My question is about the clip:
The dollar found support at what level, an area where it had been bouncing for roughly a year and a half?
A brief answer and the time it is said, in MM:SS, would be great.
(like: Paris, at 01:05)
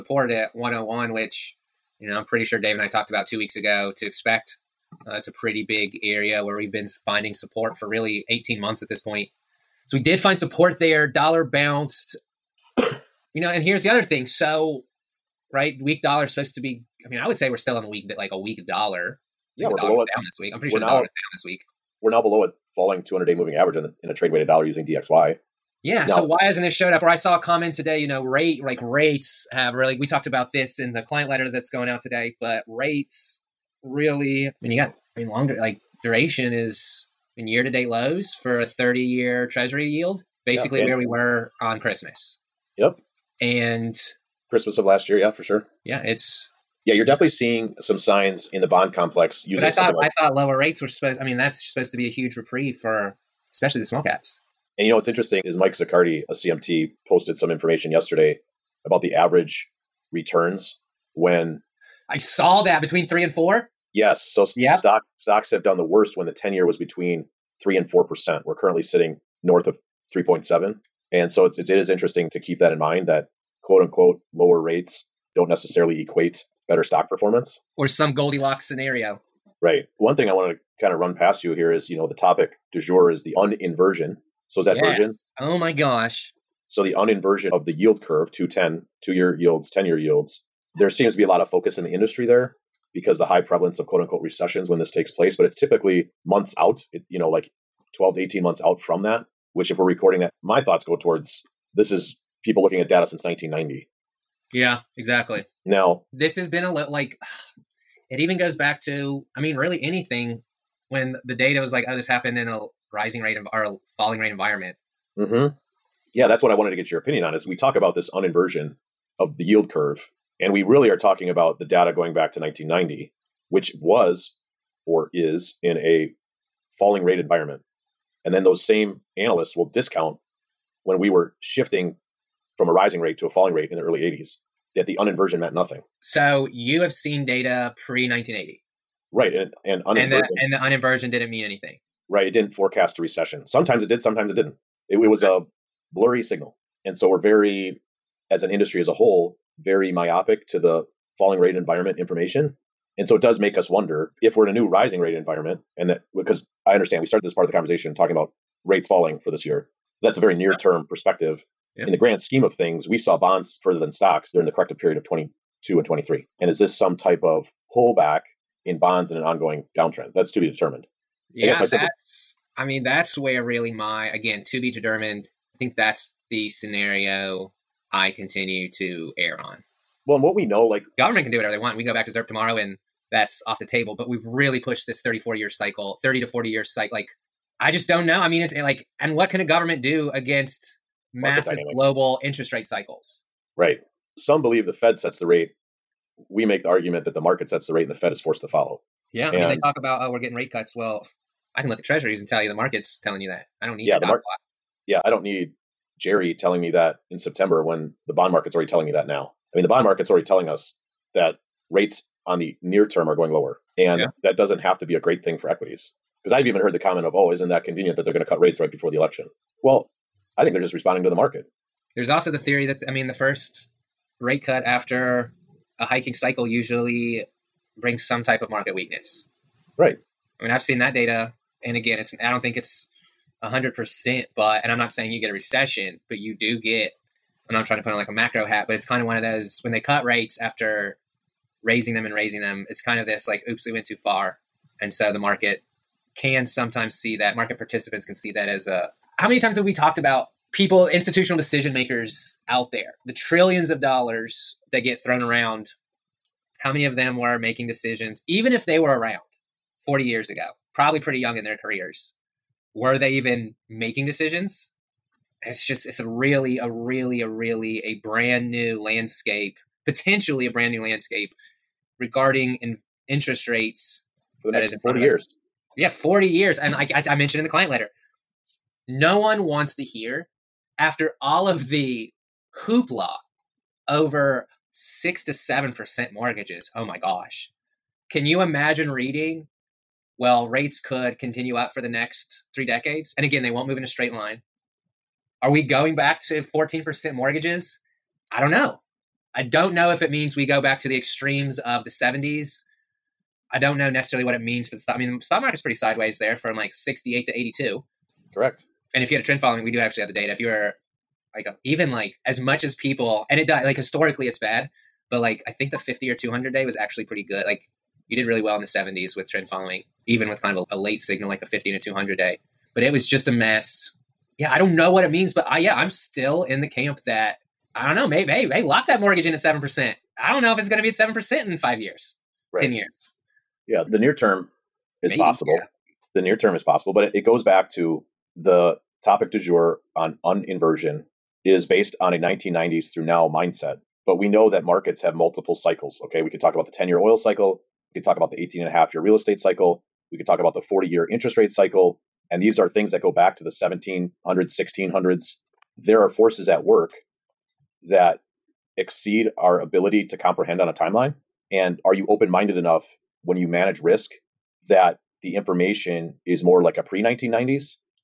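101, at 00:00.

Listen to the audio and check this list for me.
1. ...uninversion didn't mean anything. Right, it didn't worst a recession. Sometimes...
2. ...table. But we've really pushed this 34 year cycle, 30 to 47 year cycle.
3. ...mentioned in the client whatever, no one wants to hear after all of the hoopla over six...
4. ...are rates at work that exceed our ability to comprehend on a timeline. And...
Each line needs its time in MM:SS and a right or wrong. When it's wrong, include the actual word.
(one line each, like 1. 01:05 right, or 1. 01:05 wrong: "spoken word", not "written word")
1. 02:20 wrong: "forecast", not "worst"
2. 03:03 wrong: "40", not "47"
3. 04:37 wrong: "letter", not "whatever"
4. 05:56 wrong: "forces", not "rates".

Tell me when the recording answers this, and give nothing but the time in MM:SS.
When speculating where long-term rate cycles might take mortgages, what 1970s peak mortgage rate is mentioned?
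04:56.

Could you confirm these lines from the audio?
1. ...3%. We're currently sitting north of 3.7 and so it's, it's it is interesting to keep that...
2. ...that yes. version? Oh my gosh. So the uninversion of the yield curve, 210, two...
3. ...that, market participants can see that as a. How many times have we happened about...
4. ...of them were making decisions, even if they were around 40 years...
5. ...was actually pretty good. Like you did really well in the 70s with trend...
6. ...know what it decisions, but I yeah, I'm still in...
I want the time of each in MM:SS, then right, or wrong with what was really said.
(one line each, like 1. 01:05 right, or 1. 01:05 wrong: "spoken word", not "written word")
1. 01:07 wrong: "4", not "3"
2. 01:24 right
3. 04:07 wrong: "talked", not "happened"
4. 04:16 right
5. 05:16 right
6. 05:24 wrong: "means", not "decisions".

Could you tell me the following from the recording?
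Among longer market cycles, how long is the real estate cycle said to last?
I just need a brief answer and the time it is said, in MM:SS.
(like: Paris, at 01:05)
18.5 years, at 05:48.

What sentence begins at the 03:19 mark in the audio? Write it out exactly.
Yeah, I mean, they talk about oh, we're getting rate cuts.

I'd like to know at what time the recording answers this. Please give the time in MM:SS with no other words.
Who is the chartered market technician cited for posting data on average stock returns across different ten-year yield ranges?
00:55.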